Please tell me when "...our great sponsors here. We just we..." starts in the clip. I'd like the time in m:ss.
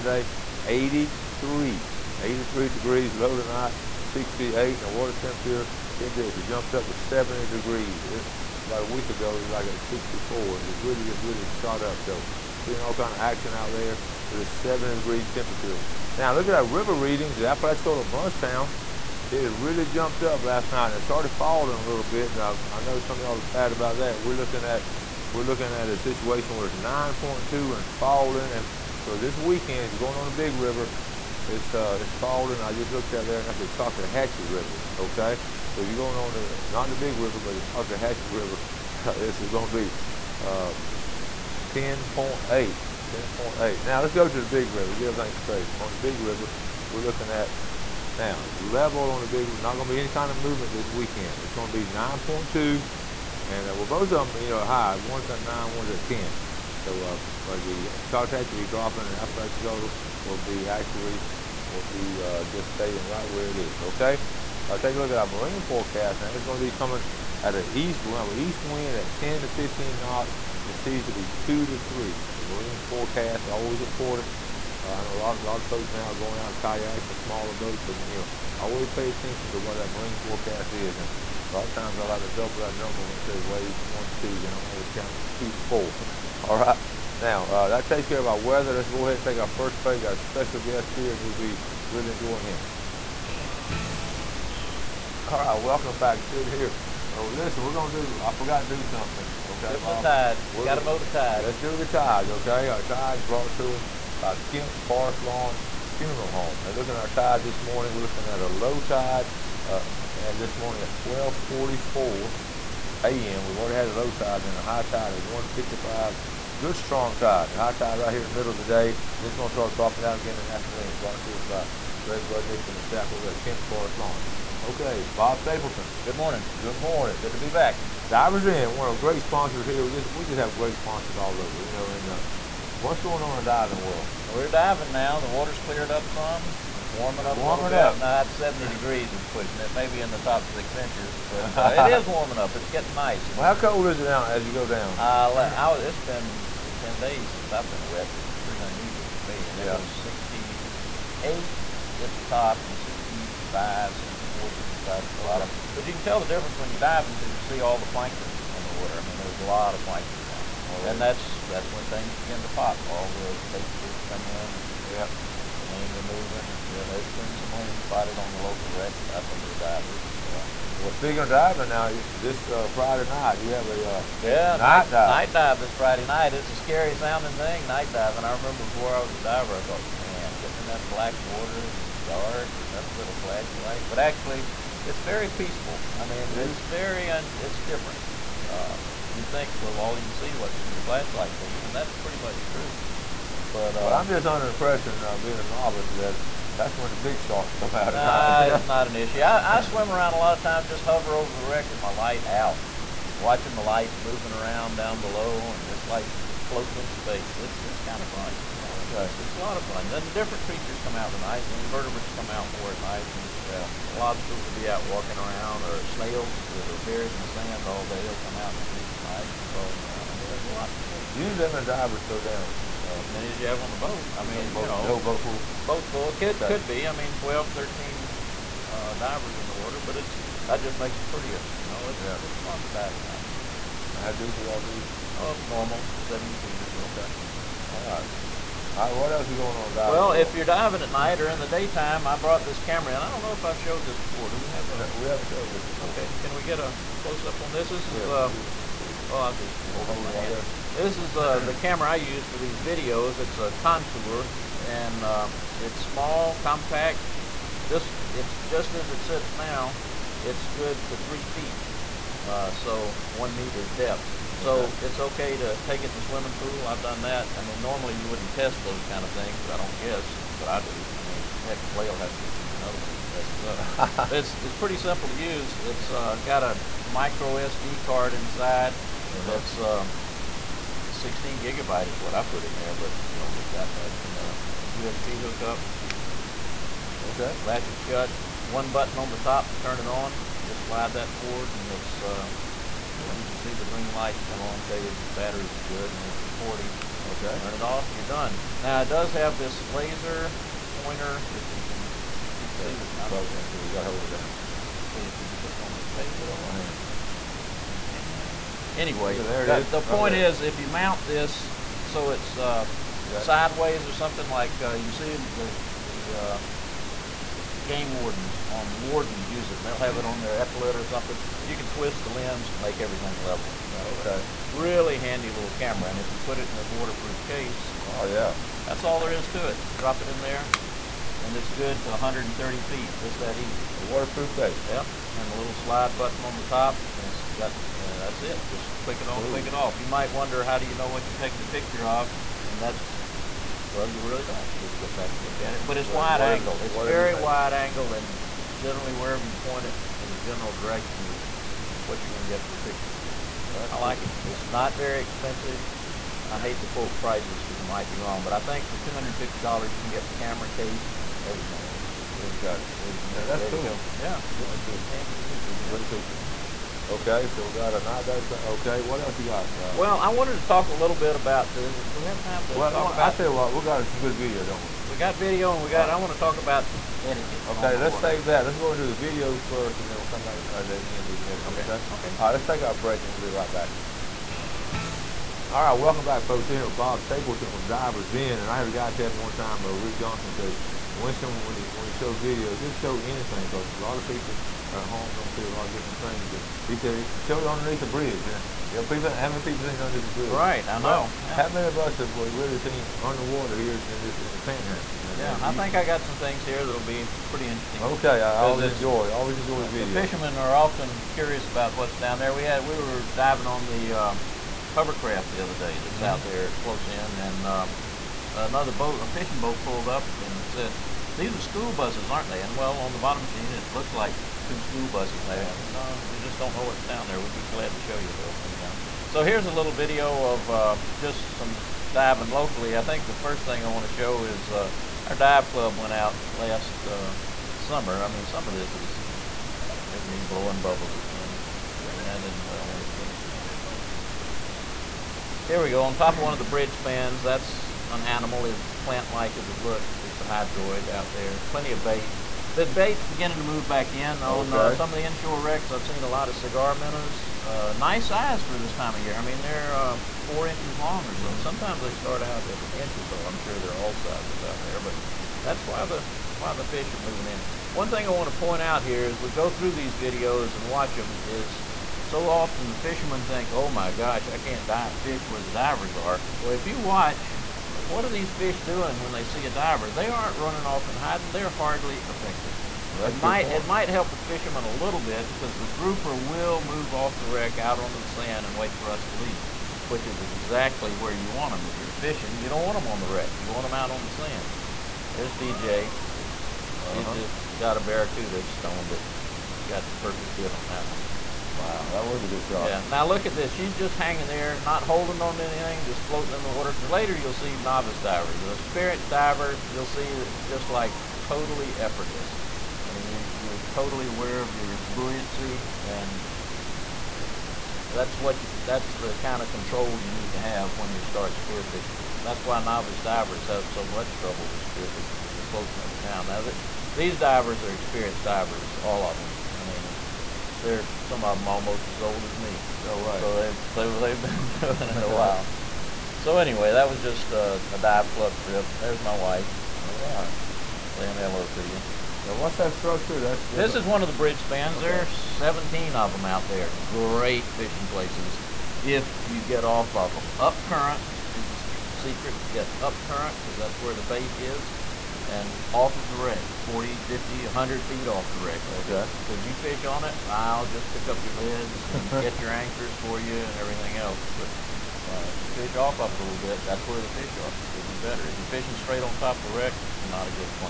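2:08.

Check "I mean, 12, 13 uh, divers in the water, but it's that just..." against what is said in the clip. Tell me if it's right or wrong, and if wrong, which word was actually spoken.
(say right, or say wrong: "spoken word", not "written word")
right.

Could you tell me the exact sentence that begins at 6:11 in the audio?
Do, it, do we have time to well, talk well, about?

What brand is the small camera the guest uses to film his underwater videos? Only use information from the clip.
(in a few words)
Contour.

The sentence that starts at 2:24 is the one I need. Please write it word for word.
Uh, I, it's been 10 days since I've been wet, which is pretty unusual for me, and yeah.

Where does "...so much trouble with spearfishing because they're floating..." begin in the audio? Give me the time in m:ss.
8:43.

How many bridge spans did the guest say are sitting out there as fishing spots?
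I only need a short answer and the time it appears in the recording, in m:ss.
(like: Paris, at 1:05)
17, at 9:05.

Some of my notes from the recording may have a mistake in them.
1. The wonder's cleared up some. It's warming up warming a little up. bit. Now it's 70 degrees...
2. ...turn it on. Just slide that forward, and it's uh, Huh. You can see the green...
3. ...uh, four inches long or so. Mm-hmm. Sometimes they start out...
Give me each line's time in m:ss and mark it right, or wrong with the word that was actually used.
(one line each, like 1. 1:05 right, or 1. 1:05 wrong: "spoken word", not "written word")
1. 2:15 wrong: "water", not "wonder"
2. 4:49 right
3. 7:39 right.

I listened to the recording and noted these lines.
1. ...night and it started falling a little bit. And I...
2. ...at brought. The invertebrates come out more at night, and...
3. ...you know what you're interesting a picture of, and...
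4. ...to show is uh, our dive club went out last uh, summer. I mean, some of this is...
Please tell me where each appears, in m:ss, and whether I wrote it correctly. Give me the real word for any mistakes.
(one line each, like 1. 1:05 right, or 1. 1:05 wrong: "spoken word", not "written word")
1. 0:20 right
2. 3:31 wrong: "night", not "brought"
3. 5:40 wrong: "taking", not "interesting"
4. 7:13 right.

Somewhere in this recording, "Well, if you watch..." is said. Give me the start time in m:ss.
7:56.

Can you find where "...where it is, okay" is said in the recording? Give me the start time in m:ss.
1:03.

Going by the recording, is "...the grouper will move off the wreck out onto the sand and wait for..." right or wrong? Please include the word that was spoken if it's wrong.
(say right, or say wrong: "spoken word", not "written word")
right.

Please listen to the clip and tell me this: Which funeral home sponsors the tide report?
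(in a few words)
Kent Forest Lawn Funeral Home.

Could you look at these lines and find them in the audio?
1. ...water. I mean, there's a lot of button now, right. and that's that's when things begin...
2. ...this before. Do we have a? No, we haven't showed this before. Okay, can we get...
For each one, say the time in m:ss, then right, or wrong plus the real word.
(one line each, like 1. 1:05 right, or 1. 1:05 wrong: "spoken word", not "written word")
1. 2:38 wrong: "plankton", not "button"
2. 4:03 right.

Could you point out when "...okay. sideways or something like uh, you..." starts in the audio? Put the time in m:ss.
5:13.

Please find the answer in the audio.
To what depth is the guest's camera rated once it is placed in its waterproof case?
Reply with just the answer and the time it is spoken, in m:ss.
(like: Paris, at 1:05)
130 feet, at 5:31.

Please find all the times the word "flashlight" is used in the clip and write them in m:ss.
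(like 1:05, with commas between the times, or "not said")
3:03, 3:10.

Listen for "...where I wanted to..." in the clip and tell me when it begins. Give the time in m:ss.
7:22.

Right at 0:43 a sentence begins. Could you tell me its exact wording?
Now let's go to the Big River, get everything straight.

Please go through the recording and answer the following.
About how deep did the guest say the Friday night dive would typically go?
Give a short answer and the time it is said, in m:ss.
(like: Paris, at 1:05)
70 feet, at 3:56.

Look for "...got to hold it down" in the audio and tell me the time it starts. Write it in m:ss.
5:03.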